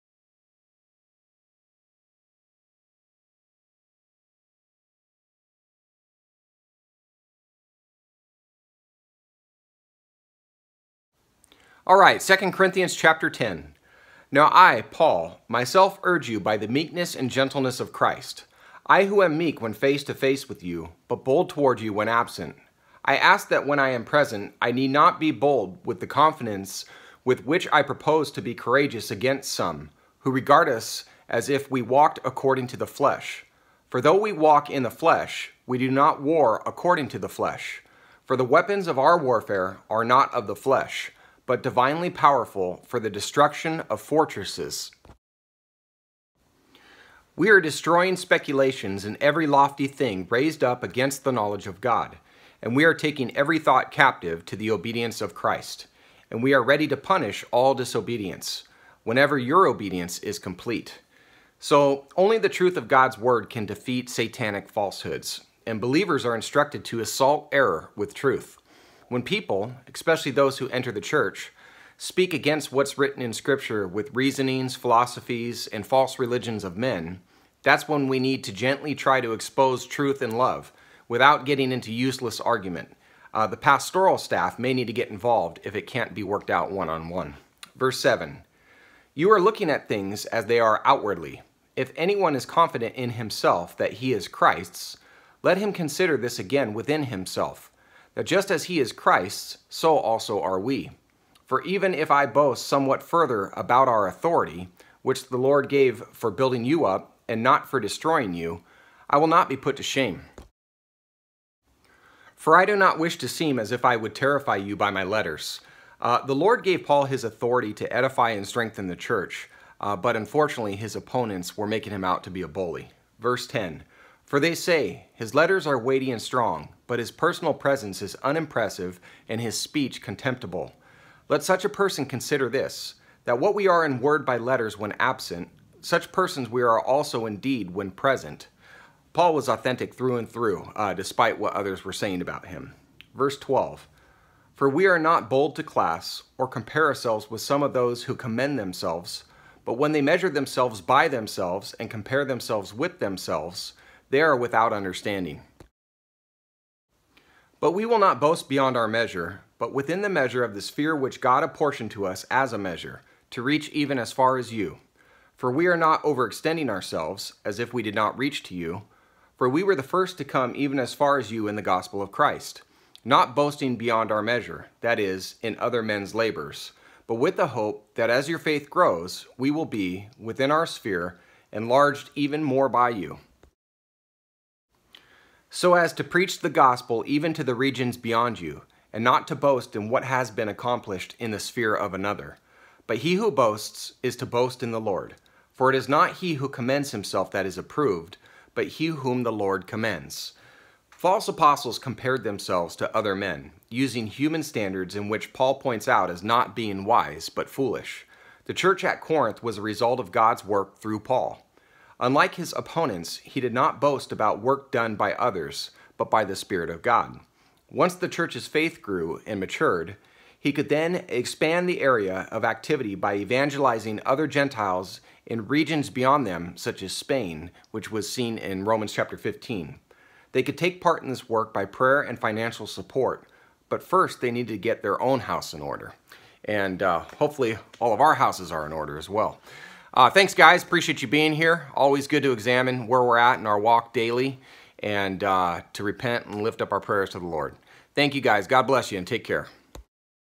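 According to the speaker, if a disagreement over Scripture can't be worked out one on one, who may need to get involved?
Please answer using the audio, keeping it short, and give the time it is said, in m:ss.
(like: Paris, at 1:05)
the pastoral staff, at 1:23.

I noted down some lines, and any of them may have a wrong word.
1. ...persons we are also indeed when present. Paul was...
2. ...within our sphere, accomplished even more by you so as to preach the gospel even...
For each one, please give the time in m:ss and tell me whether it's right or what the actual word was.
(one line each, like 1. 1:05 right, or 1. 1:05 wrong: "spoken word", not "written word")
1. 2:16 right
2. 3:00 wrong: "enlarged", not "accomplished".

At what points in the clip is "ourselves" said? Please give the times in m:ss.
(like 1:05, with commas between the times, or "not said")
2:26, 2:46.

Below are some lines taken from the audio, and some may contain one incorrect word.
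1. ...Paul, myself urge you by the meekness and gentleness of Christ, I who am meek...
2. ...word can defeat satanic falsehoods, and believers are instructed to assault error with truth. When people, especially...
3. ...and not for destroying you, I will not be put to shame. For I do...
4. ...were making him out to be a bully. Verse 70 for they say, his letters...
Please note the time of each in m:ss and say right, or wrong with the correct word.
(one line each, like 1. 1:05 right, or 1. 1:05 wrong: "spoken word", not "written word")
1. 0:14 right
2. 1:03 right
3. 1:47 right
4. 2:01 wrong: "10", not "70".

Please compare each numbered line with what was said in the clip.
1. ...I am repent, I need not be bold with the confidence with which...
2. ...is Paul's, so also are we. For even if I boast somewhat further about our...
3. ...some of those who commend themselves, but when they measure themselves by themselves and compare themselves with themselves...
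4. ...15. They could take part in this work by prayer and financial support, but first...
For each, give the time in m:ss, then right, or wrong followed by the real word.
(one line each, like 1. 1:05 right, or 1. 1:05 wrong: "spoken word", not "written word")
1. 0:23 wrong: "present", not "repent"
2. 1:38 wrong: "Christ", not "Paul"
3. 2:27 right
4. 3:49 right.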